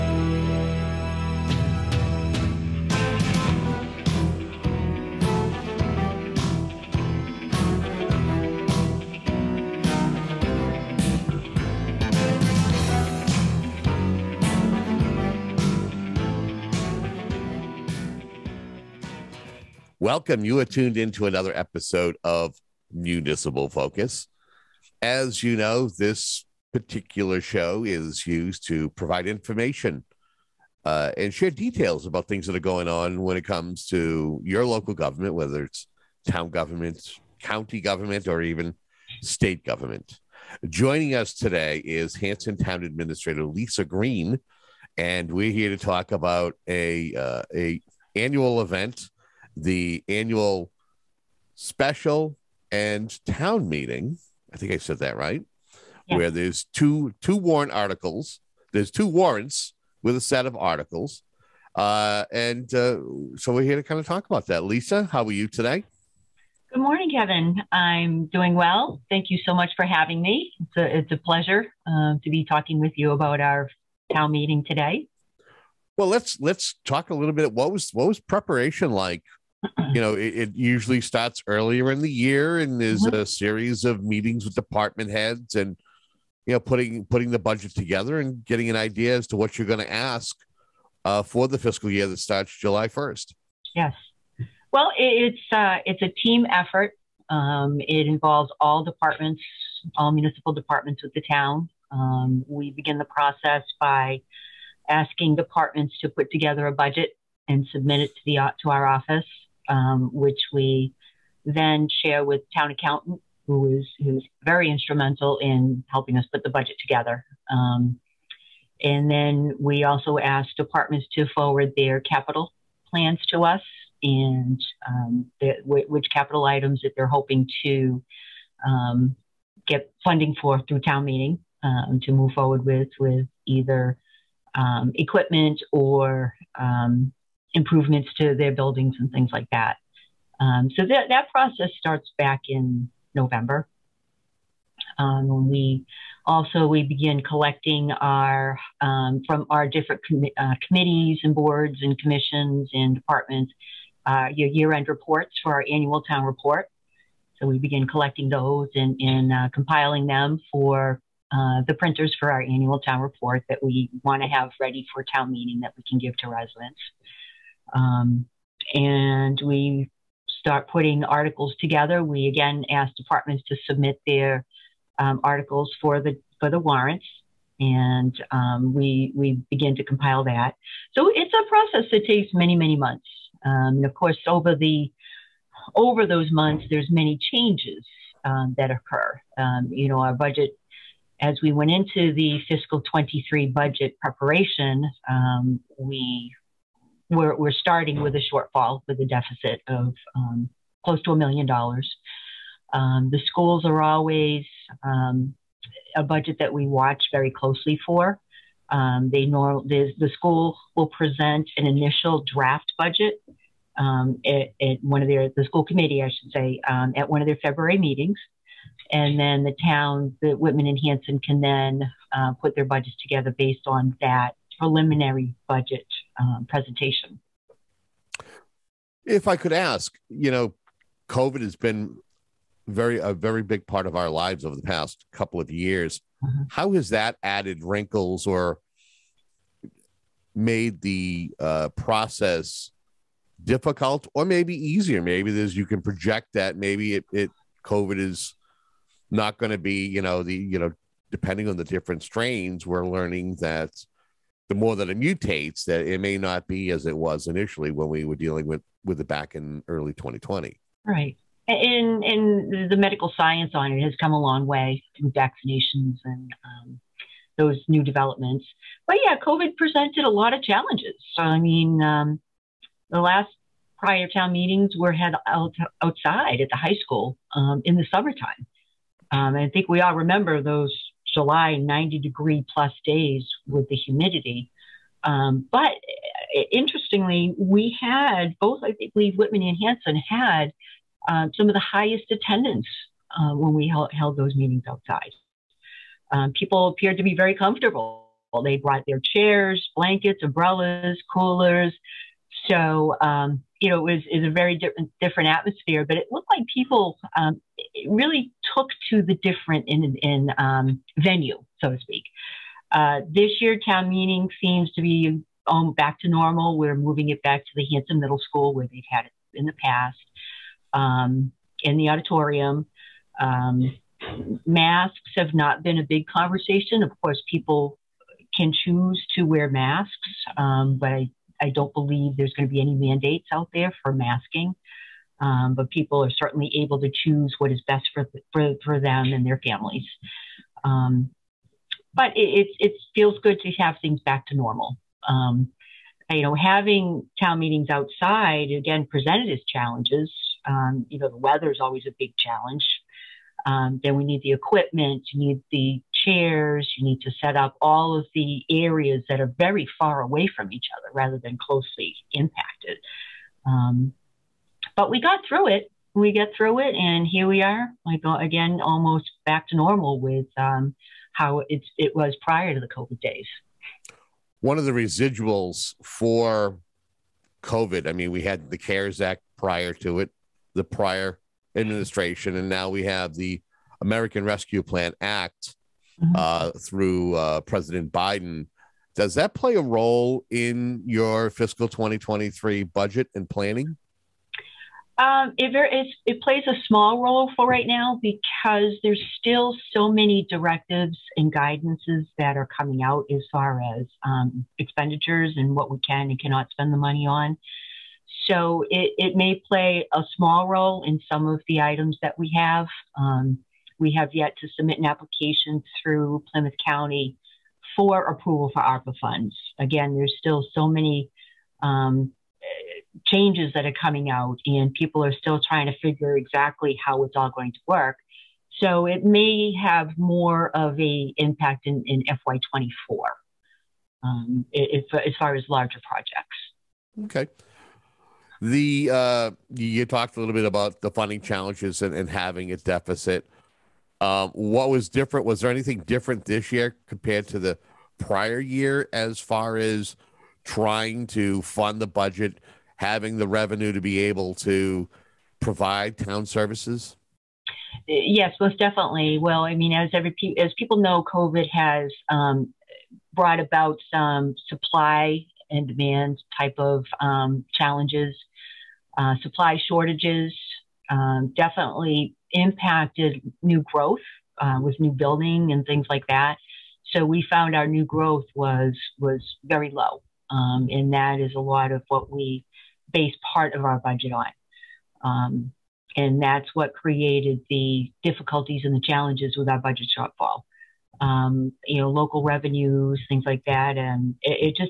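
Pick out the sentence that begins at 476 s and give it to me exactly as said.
So we found our new growth was was very low.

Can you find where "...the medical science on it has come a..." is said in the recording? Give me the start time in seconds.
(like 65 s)
262 s.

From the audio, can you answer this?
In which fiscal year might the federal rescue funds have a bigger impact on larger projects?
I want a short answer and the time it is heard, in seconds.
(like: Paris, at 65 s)
FY24, at 432 s.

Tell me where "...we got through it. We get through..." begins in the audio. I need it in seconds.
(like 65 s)
364 s.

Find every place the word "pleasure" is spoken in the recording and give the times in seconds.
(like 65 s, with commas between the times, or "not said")
71 s.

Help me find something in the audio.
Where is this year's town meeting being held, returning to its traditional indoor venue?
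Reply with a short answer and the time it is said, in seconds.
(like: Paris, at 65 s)
Hanson Middle School, at 317 s.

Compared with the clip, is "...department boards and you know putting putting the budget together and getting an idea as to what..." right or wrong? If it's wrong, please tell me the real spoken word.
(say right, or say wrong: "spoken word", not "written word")
wrong: "heads", not "boards".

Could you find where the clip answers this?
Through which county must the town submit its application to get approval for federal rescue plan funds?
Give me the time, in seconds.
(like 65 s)
416 s.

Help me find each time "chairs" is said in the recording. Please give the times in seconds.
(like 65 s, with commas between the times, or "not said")
299 s, 356 s.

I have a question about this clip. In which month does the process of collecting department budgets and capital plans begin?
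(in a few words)
November.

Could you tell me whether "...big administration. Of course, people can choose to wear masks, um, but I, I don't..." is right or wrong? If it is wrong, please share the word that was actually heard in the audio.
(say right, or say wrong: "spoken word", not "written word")
wrong: "conversation", not "administration".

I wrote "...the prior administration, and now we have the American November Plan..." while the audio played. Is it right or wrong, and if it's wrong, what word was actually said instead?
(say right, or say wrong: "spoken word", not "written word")
wrong: "Rescue", not "November".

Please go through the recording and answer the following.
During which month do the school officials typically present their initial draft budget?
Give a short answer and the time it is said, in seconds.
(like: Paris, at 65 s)
February, at 217 s.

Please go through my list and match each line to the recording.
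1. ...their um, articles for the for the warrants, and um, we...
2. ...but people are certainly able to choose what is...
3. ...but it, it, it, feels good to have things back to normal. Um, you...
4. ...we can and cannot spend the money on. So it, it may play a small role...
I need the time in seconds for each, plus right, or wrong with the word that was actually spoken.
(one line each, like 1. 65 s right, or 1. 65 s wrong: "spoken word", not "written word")
1. 174 s right
2. 335 s right
3. 341 s right
4. 405 s right.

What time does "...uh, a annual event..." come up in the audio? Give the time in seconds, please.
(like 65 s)
47 s.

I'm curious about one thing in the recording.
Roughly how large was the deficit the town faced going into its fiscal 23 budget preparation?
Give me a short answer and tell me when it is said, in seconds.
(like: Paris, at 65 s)
a million dollars, at 201 s.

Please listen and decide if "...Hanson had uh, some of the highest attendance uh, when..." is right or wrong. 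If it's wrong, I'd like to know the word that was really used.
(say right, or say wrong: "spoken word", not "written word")
right.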